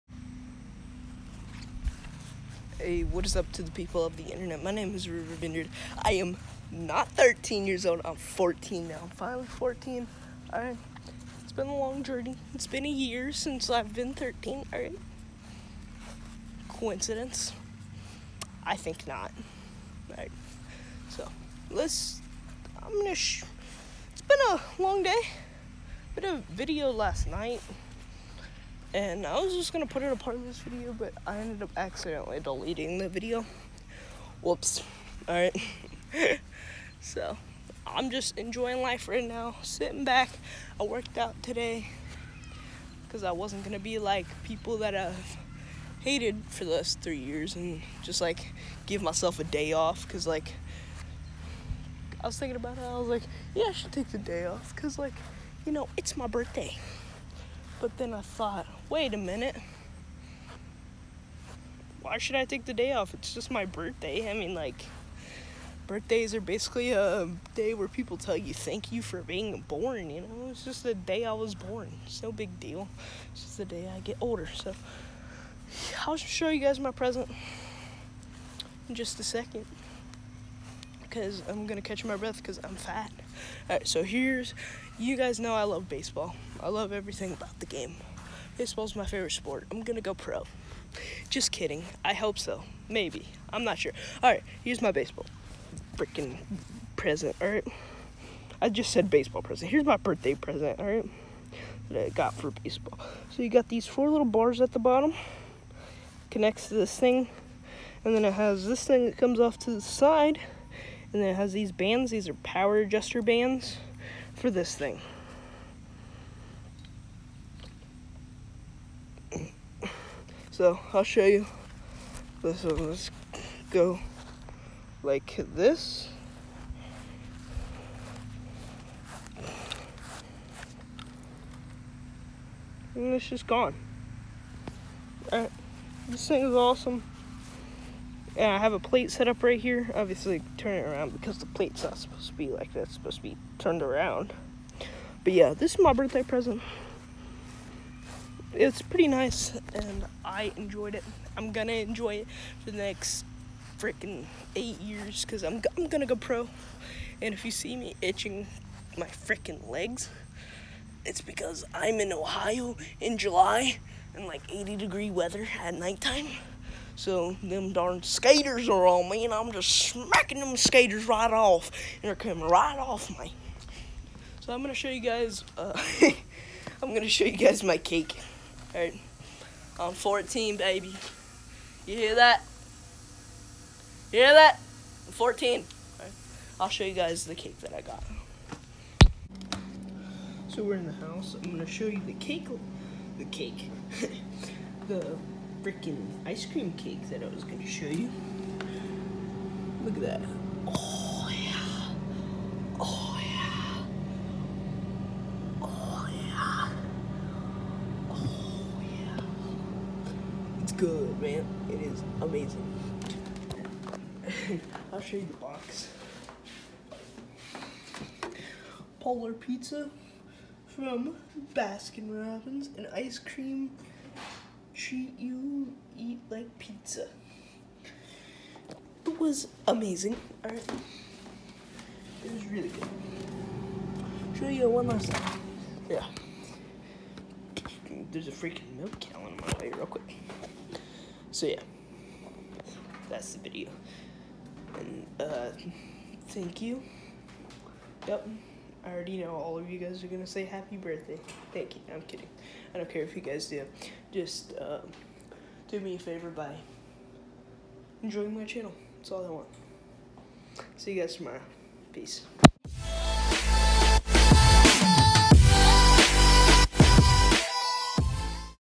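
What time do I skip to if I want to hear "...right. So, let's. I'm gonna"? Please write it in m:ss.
0:20.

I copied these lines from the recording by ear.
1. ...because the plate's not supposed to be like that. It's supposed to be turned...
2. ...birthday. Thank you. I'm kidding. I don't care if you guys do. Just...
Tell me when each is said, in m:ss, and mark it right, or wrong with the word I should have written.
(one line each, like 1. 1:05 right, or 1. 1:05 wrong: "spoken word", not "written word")
1. 2:21 right
2. 4:10 right.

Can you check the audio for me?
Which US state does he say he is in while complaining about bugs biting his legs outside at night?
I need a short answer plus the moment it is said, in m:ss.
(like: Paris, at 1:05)
Ohio, at 2:42.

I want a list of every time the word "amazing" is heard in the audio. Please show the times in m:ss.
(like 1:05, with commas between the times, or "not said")
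3:32, 3:49.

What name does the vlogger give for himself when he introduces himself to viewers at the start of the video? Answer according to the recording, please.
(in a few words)
River Vineyard.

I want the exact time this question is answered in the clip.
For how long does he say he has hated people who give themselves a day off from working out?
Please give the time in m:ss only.
0:47.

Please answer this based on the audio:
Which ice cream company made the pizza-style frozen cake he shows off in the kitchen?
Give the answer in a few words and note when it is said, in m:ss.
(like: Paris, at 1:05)
Baskin Robbins, at 3:41.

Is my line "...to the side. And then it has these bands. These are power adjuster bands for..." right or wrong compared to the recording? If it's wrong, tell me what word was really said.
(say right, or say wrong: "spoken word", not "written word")
right.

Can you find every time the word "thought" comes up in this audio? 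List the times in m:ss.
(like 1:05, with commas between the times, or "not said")
0:58.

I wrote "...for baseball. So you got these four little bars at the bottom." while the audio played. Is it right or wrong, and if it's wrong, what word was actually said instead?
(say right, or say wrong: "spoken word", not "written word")
right.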